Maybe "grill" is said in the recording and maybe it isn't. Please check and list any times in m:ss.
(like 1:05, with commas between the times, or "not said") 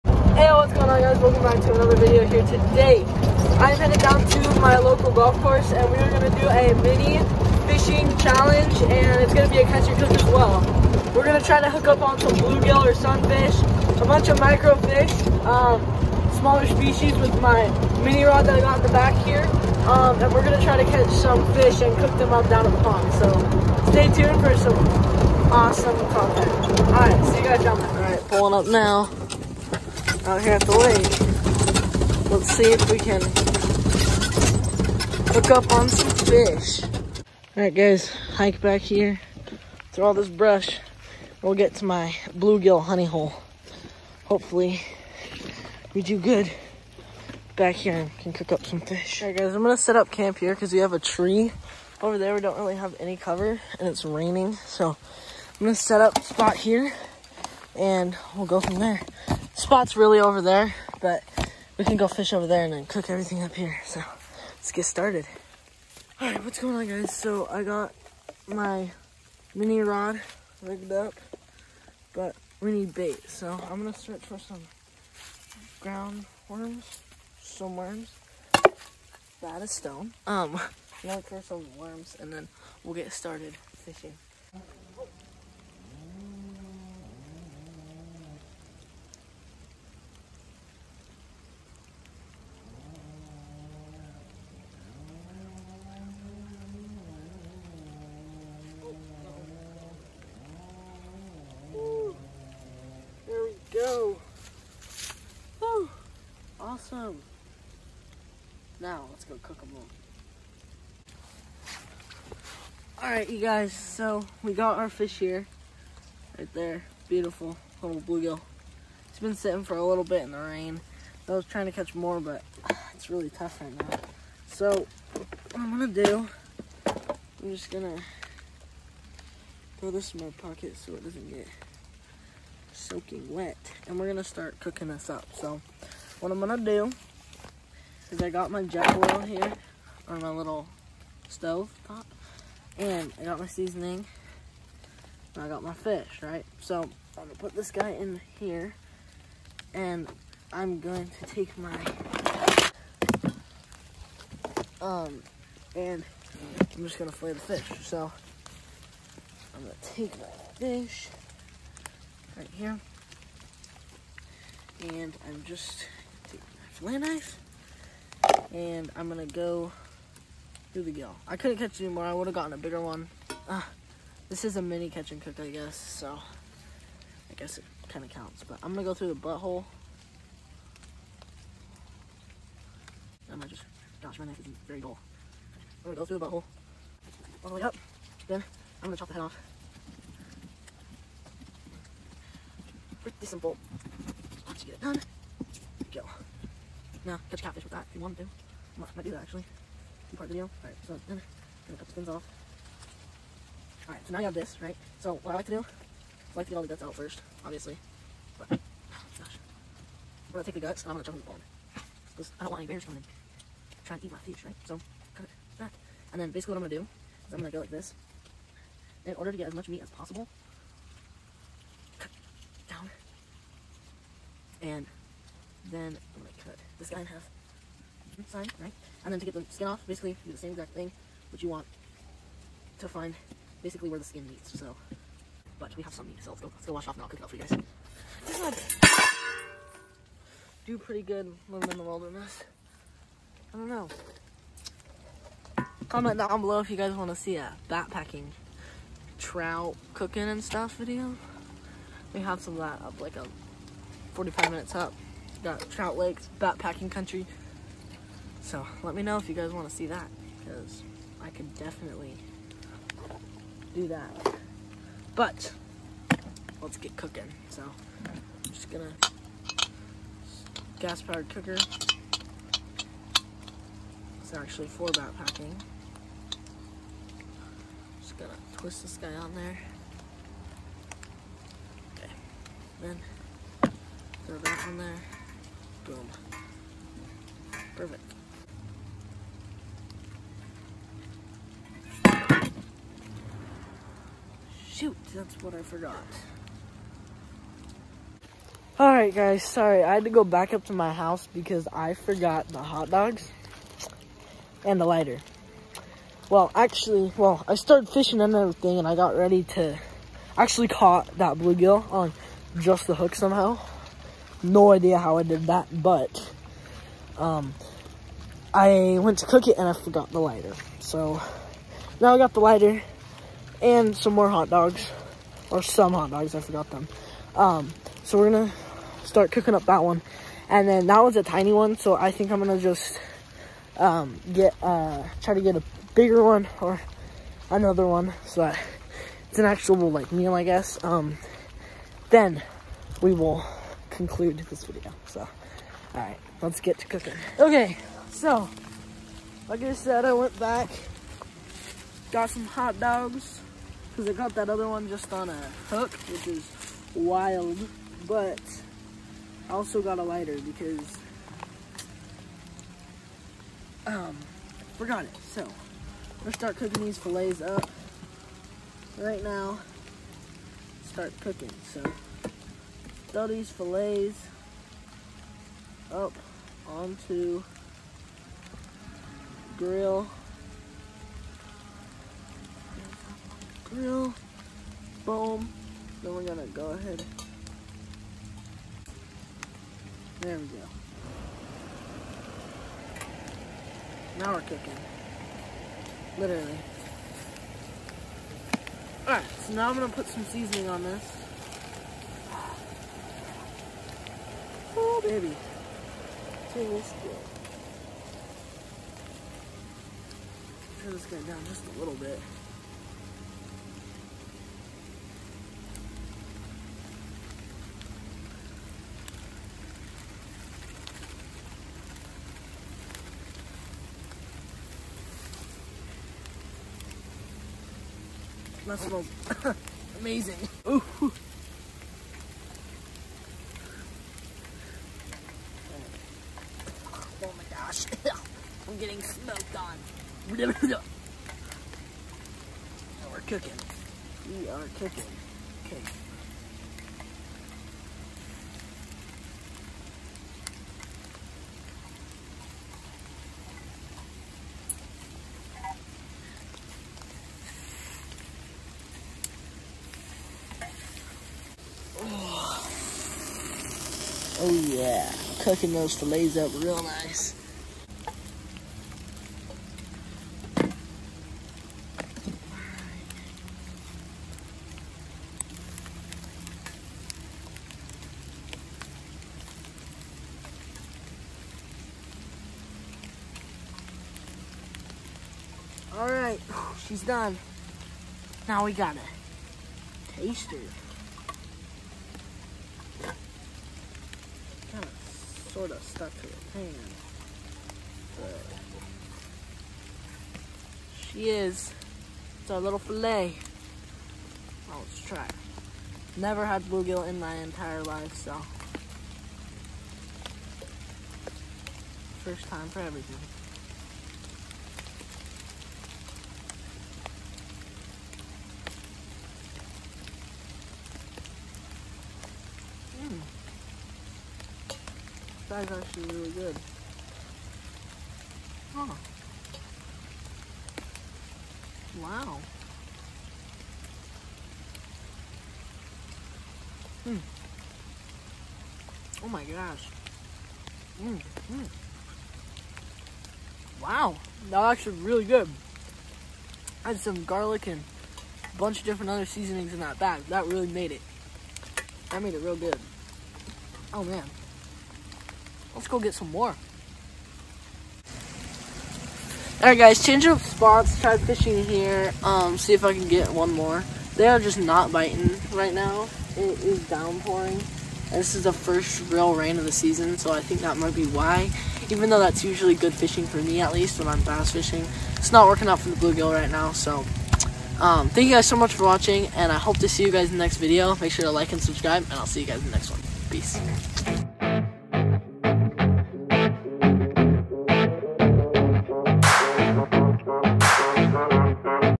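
6:19, 6:23.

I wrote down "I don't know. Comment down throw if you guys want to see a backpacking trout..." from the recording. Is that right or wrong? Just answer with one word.
wrong.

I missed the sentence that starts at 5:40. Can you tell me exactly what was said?
Um, then we will conclude this video.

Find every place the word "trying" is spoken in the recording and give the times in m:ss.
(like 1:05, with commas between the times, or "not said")
2:01, 3:33.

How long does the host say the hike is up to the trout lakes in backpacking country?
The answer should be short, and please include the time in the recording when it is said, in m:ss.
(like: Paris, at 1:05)
45 minutes, at 4:14.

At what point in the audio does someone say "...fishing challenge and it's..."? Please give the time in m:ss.
0:07.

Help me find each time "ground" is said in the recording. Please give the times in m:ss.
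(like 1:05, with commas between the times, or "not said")
1:15.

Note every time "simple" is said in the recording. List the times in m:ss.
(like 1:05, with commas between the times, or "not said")
3:13.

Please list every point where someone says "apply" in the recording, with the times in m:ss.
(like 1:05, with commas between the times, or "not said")
not said.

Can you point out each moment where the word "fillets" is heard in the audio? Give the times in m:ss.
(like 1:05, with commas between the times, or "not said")
6:06, 6:13, 7:45.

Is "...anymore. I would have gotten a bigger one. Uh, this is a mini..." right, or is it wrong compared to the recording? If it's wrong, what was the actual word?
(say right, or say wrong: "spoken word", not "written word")
right.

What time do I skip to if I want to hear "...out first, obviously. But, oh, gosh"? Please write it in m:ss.
3:26.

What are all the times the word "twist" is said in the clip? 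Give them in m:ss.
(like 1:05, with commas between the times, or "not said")
4:38.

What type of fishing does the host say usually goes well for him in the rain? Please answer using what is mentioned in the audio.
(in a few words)
Bass fishing.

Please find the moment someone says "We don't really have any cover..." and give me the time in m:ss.
0:52.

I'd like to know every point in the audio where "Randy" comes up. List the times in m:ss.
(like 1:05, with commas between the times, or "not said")
not said.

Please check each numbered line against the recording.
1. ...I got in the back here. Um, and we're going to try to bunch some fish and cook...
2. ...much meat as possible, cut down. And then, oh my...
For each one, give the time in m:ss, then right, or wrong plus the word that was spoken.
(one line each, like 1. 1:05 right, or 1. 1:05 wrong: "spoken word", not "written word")
1. 0:18 wrong: "catch", not "bunch"
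2. 3:39 right.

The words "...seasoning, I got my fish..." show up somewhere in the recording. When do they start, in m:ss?
2:23.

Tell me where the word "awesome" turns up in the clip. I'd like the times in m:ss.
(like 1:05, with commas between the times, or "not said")
0:25, 1:46.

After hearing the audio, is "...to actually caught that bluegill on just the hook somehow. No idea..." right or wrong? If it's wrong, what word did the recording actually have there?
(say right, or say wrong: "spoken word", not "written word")
right.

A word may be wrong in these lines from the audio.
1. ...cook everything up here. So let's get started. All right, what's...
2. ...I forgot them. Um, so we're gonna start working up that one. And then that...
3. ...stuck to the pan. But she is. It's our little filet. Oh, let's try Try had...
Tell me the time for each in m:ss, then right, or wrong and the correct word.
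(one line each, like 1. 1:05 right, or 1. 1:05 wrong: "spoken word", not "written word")
1. 1:02 right
2. 5:26 wrong: "cooking", not "working"
3. 8:15 wrong: "Never", not "Try".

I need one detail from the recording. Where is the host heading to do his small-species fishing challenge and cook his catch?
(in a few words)
Local golf course.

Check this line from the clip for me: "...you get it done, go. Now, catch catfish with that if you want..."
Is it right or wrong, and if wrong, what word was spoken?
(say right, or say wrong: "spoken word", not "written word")
right.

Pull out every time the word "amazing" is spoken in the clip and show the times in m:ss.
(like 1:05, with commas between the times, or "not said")
7:09.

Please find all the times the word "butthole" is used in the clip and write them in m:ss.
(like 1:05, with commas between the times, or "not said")
2:59, 3:06.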